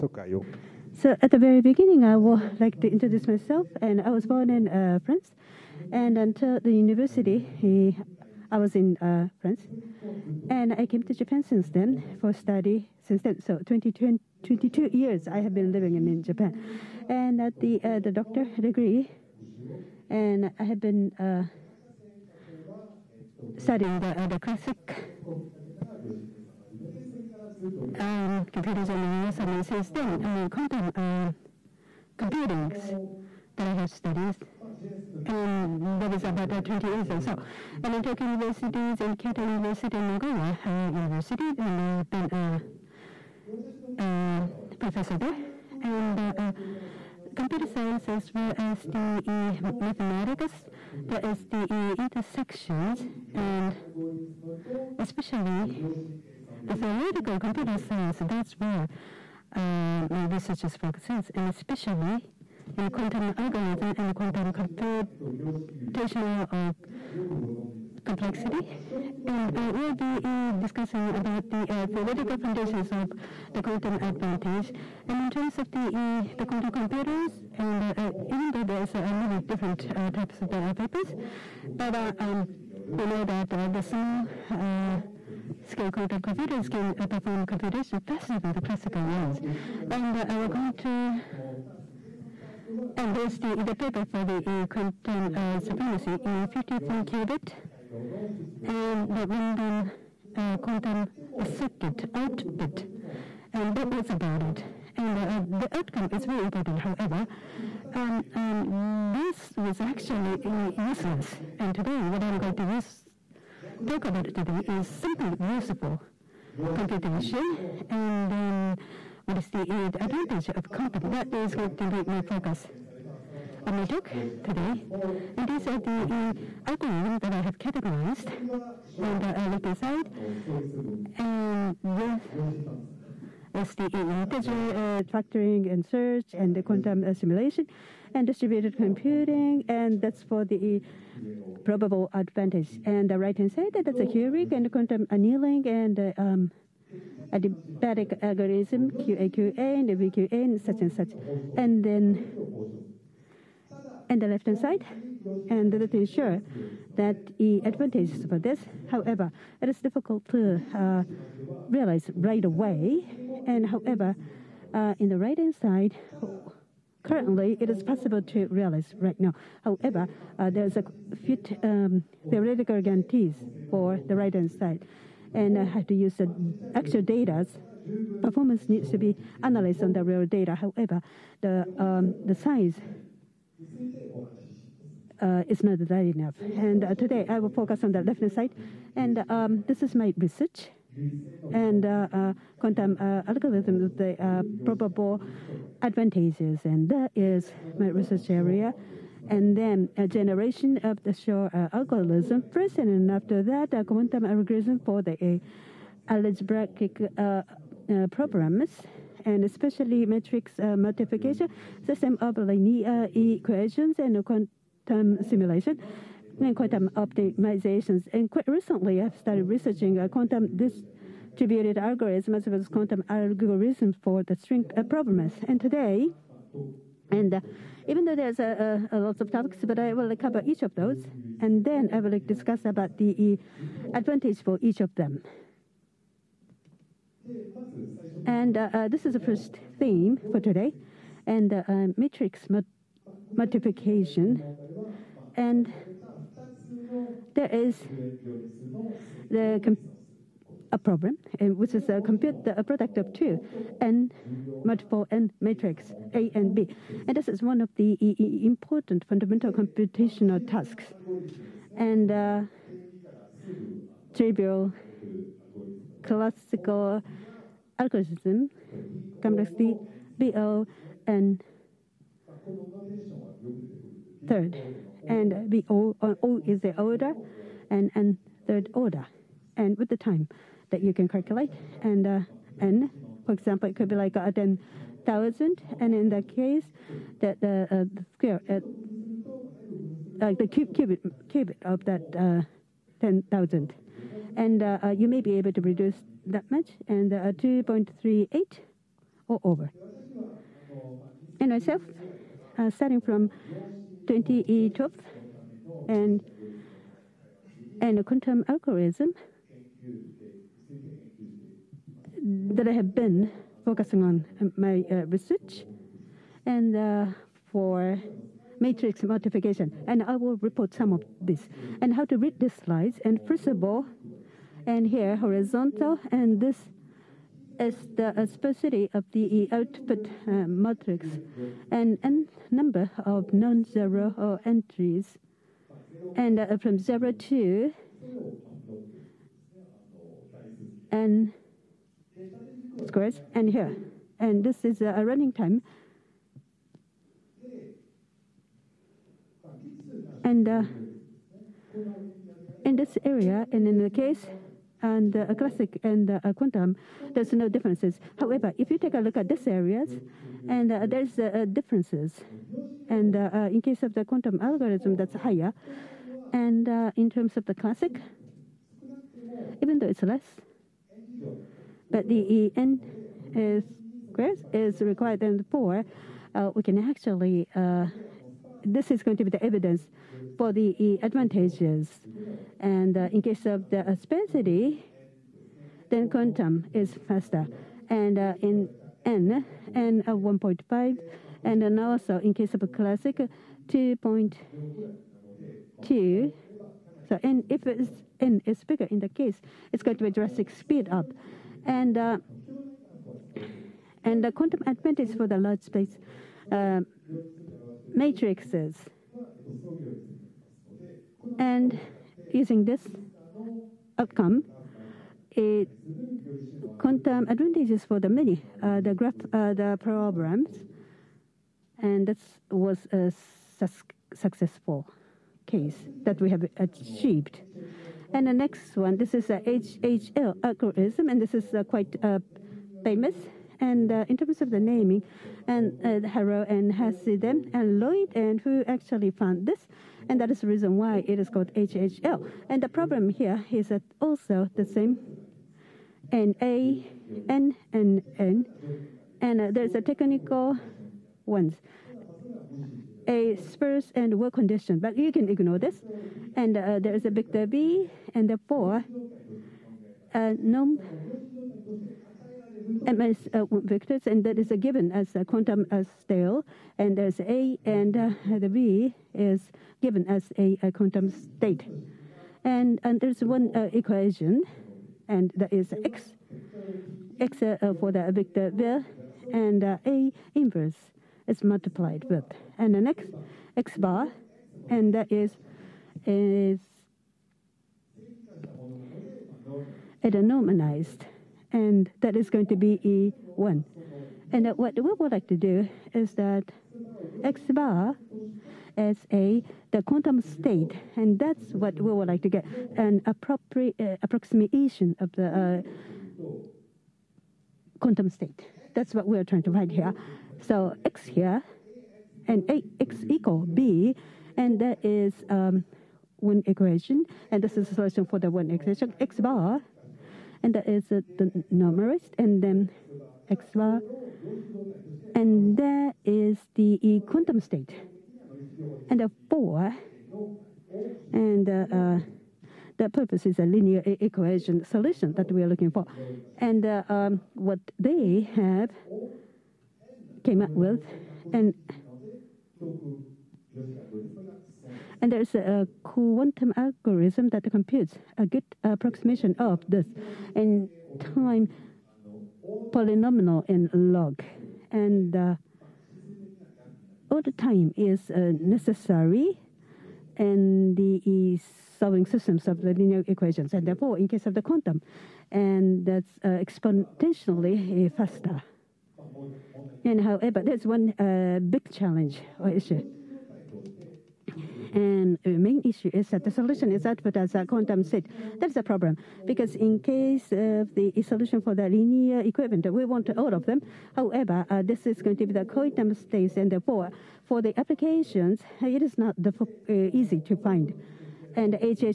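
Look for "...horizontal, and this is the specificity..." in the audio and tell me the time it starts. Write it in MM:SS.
05:25.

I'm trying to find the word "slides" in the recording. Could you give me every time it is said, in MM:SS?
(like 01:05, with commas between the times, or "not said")
05:22.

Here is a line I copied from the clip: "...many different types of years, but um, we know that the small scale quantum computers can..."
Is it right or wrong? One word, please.
wrong.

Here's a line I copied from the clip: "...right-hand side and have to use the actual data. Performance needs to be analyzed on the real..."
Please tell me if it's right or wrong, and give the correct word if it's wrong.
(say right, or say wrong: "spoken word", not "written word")
right.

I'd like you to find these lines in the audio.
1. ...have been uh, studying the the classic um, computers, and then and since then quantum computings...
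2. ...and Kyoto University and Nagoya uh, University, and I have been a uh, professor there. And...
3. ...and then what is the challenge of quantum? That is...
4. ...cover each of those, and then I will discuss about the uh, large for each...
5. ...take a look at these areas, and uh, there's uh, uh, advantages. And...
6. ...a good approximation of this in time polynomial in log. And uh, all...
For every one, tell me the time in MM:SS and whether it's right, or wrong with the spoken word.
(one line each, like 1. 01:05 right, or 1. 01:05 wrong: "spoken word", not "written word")
1. 00:20 right
2. 00:38 right
3. 01:57 wrong: "advantage", not "challenge"
4. 03:50 wrong: "advantage", not "large"
5. 05:58 wrong: "differences", not "advantages"
6. 09:08 right.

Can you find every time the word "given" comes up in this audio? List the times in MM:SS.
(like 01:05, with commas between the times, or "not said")
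07:44, 07:49.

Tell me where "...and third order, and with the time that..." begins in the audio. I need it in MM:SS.
04:37.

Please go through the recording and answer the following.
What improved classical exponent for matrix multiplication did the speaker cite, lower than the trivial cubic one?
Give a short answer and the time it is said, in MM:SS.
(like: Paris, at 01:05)
2.38, at 04:57.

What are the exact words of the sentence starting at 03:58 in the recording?
And uh, this is the first theme for today, and matrix multiplication.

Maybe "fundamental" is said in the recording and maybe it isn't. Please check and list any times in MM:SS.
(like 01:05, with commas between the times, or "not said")
04:19.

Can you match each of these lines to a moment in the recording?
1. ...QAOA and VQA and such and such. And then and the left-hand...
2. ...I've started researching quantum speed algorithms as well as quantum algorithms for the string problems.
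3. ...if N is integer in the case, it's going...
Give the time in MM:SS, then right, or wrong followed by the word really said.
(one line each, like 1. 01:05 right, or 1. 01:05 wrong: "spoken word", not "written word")
1. 02:28 right
2. 03:39 wrong: "distributed", not "speed"
3. 06:37 wrong: "bigger", not "integer".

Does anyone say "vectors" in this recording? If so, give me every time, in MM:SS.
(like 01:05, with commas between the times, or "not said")
07:43, 07:58.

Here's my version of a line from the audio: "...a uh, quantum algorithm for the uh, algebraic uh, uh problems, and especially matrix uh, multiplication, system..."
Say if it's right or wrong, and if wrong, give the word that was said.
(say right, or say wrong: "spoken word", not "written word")
right.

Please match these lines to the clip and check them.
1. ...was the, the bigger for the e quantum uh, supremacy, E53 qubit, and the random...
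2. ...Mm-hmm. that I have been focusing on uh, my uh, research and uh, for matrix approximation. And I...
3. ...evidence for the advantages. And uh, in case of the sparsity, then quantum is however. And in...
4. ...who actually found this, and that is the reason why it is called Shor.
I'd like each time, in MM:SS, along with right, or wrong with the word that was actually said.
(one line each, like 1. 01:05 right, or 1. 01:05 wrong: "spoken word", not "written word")
1. 01:33 wrong: "paper", not "bigger"
2. 05:12 wrong: "multiplication", not "approximation"
3. 06:19 wrong: "faster", not "however"
4. 07:18 wrong: "HHL", not "Shor".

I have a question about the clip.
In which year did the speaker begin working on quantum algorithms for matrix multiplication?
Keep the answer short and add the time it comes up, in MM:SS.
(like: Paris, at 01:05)
2012, at 05:04.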